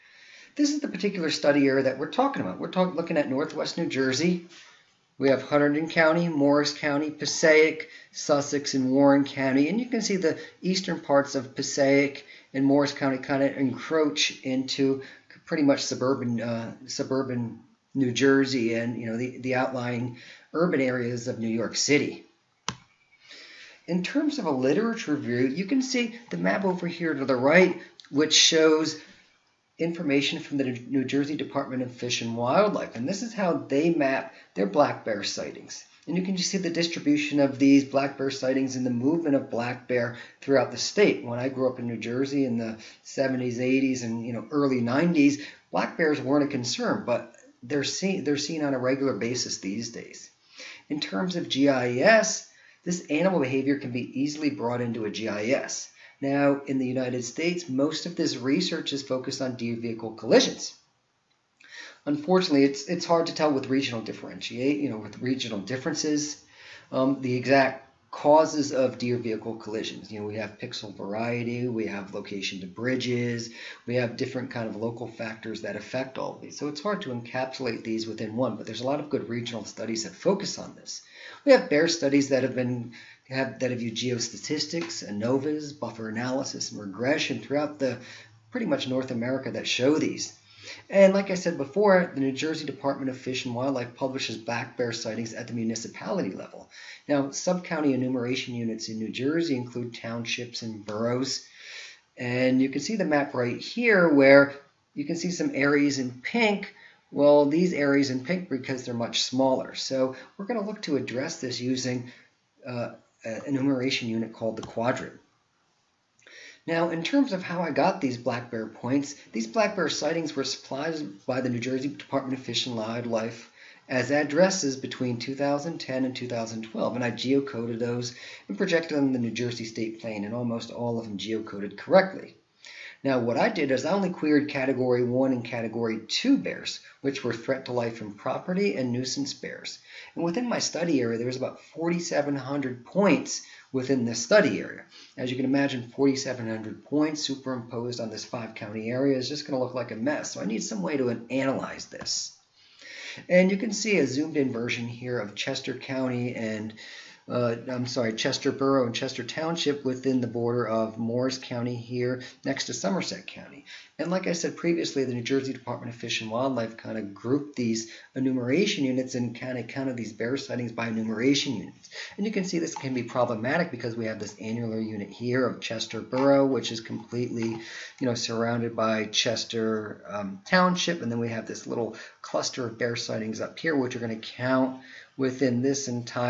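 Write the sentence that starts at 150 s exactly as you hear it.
So I need some way to analyze this.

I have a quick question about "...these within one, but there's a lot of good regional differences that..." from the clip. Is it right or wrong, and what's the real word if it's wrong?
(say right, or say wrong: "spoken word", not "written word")
wrong: "studies", not "differences".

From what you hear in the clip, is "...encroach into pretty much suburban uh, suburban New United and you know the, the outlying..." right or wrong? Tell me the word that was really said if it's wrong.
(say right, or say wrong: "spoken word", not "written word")
wrong: "Jersey", not "United".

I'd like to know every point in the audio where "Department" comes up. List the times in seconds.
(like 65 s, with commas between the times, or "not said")
31 s, 92 s, 121 s, 165 s.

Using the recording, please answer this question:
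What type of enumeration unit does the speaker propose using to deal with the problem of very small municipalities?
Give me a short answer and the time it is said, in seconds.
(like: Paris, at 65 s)
Quadrant, at 114 s.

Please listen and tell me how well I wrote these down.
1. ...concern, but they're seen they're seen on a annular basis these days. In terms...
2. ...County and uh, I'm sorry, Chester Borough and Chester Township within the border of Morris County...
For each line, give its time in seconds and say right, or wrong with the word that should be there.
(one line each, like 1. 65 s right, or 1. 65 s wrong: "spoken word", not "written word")
1. 46 s wrong: "regular", not "annular"
2. 155 s right.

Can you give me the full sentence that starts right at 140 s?
And within my study area, there was about 4,700 points within this study area.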